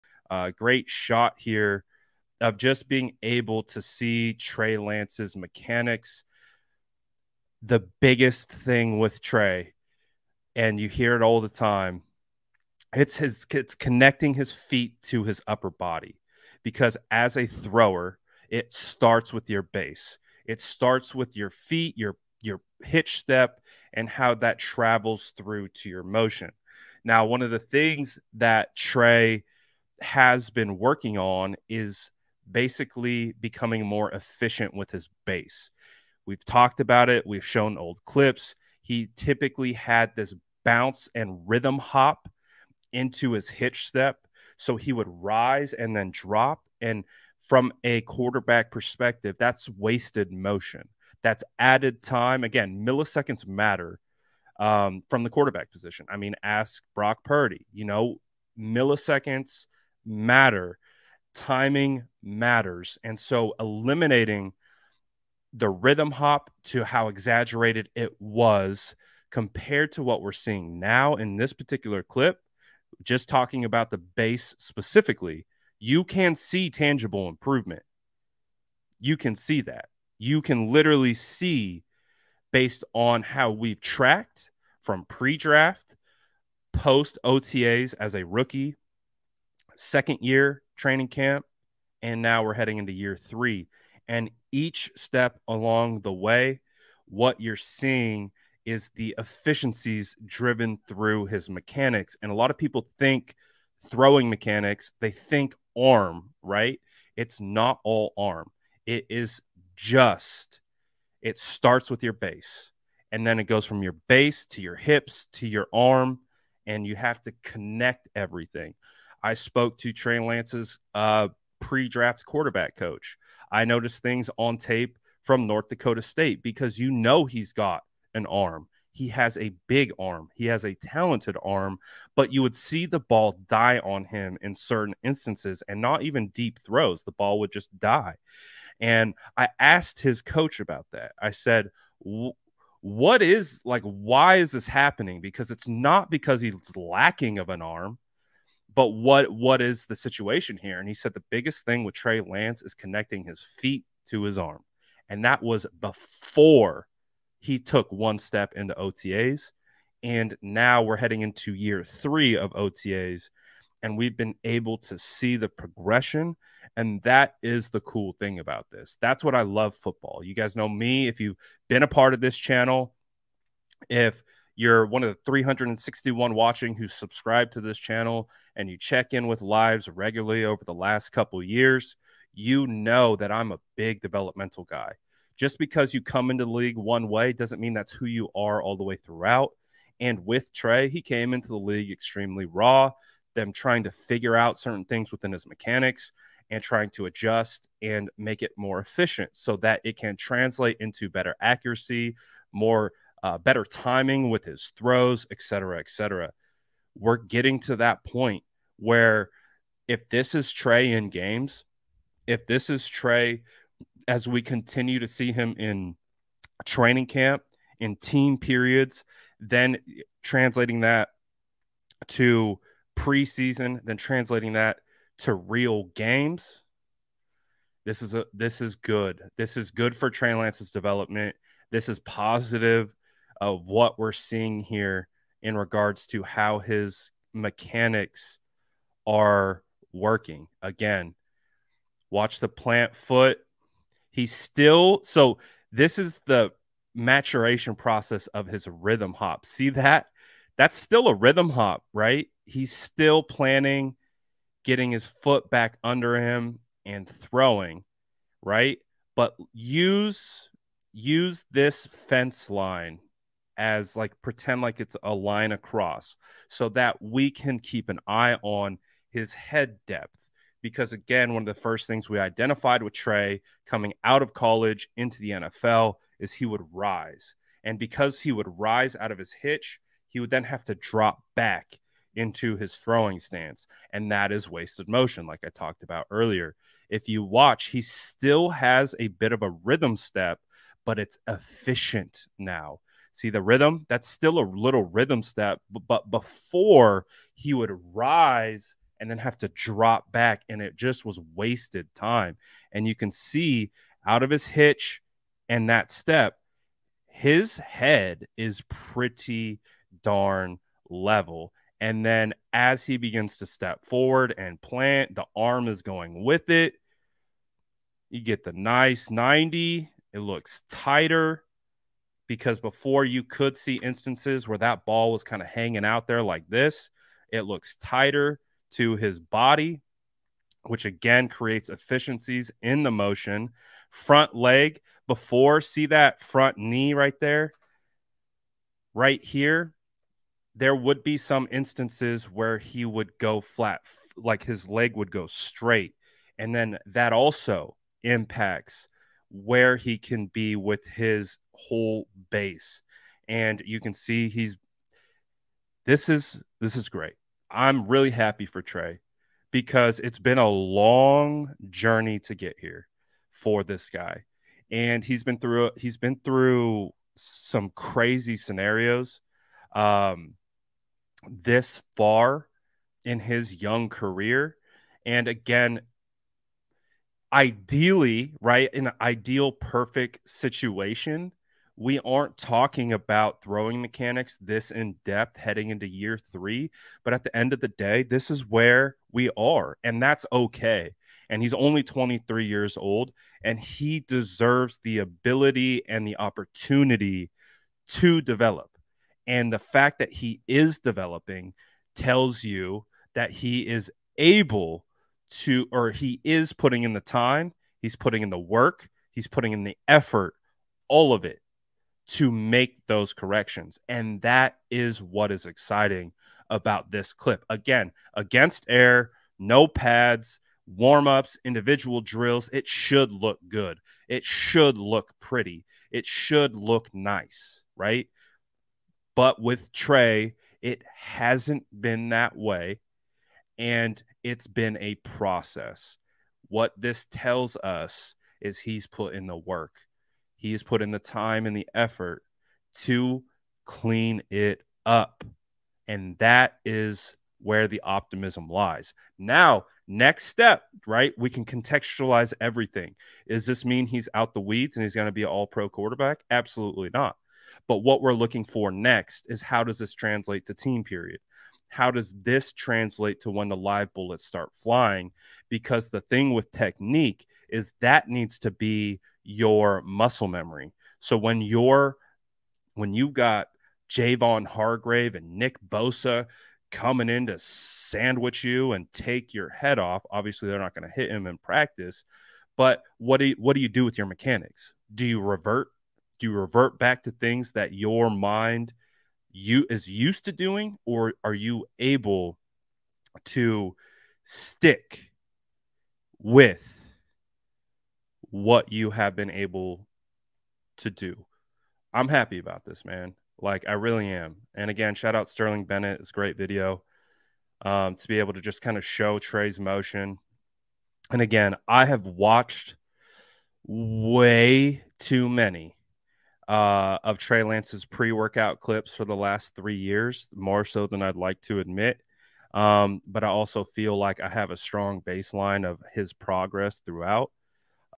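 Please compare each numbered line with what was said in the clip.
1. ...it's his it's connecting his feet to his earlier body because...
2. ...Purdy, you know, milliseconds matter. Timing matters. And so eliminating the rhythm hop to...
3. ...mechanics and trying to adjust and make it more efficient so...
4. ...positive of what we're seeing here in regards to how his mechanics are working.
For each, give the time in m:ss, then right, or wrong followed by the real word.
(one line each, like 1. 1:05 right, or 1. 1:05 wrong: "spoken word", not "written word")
1. 0:12 wrong: "upper", not "earlier"
2. 0:57 right
3. 3:15 right
4. 3:51 right.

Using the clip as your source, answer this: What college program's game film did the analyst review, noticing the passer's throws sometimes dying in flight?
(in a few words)
North Dakota State.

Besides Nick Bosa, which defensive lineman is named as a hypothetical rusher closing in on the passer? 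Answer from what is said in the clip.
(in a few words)
Javon Hargrave.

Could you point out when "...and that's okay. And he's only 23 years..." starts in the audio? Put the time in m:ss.
6:29.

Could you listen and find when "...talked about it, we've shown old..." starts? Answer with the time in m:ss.
0:36.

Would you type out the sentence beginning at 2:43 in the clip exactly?
And we've been able to see the progression.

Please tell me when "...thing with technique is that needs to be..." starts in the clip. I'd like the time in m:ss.
7:46.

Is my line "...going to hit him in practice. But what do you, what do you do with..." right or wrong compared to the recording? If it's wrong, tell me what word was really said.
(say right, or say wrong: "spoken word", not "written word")
right.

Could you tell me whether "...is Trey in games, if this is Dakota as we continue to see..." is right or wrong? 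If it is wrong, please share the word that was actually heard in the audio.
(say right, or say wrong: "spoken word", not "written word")
wrong: "Trey", not "Dakota".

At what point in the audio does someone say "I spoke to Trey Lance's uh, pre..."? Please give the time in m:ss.
1:59.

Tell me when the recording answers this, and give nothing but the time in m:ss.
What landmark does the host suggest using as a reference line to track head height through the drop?
4:21.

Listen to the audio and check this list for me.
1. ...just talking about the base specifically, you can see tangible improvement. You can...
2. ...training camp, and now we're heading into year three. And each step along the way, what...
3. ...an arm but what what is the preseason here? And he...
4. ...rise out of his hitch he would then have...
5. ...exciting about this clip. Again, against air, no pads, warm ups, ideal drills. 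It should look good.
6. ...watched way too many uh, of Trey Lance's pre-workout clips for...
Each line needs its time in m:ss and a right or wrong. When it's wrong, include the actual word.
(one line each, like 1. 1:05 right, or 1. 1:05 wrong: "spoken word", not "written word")
1. 1:13 right
2. 1:30 right
3. 2:27 wrong: "situation", not "preseason"
4. 4:38 right
5. 6:55 wrong: "individual", not "ideal"
6. 8:32 right.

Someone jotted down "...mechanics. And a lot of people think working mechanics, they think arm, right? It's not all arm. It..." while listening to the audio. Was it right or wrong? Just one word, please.
wrong.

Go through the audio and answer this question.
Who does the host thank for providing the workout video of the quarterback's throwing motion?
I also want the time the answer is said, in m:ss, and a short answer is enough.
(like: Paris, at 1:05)
Sterling Bennett, at 8:25.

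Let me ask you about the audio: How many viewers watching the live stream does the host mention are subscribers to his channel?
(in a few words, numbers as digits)
361.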